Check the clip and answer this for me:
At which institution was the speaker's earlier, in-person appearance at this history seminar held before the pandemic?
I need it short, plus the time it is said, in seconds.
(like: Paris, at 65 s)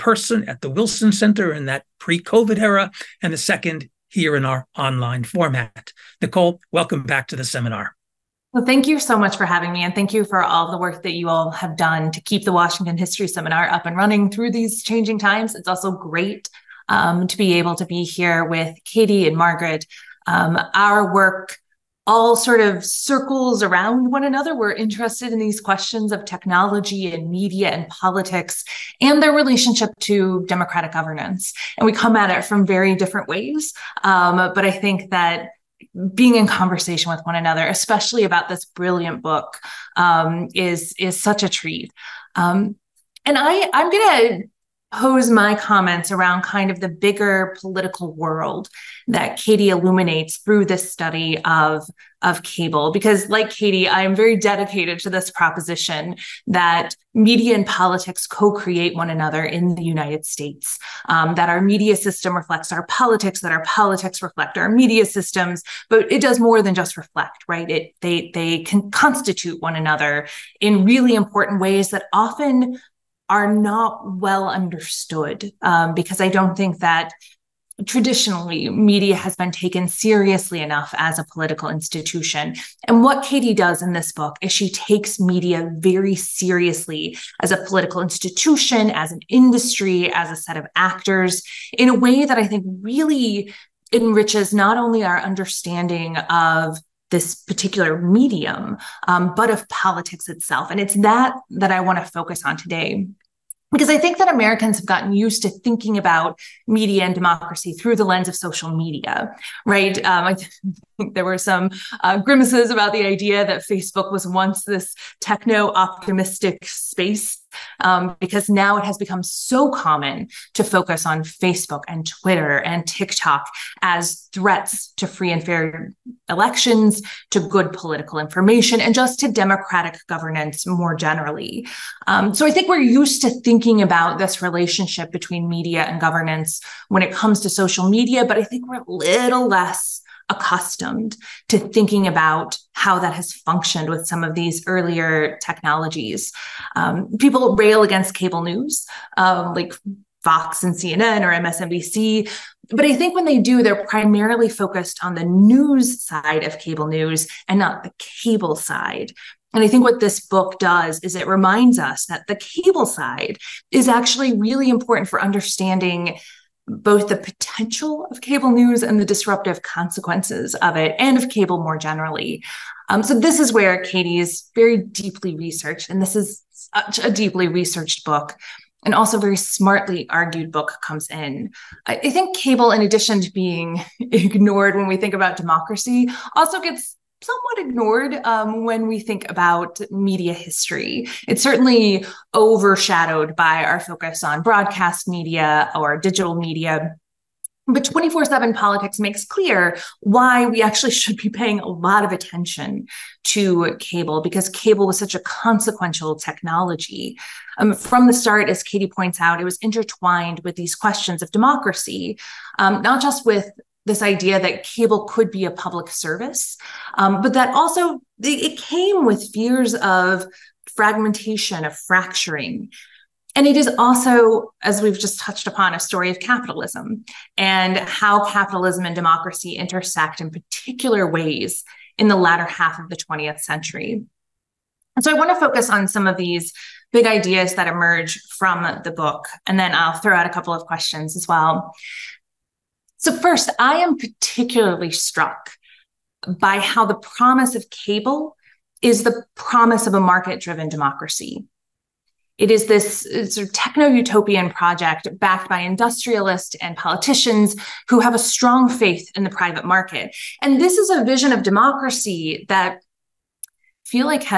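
Wilson Center, at 0 s.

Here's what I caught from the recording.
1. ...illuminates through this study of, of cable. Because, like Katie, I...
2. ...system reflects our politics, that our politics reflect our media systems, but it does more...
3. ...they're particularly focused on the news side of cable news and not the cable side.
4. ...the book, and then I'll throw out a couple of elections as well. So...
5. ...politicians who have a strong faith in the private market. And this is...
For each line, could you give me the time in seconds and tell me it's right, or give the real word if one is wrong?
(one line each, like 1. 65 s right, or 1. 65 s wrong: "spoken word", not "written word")
1. 49 s right
2. 61 s right
3. 153 s wrong: "primarily", not "particularly"
4. 238 s wrong: "questions", not "elections"
5. 256 s right.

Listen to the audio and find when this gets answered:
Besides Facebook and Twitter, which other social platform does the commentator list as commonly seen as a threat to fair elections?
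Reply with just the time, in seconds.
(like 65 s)
122 s.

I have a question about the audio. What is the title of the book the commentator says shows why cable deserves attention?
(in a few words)
24/7 Politics.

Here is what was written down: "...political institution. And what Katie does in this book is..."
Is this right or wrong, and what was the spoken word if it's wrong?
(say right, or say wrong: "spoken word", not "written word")
right.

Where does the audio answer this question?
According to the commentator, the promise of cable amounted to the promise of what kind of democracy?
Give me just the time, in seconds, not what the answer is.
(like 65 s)
249 s.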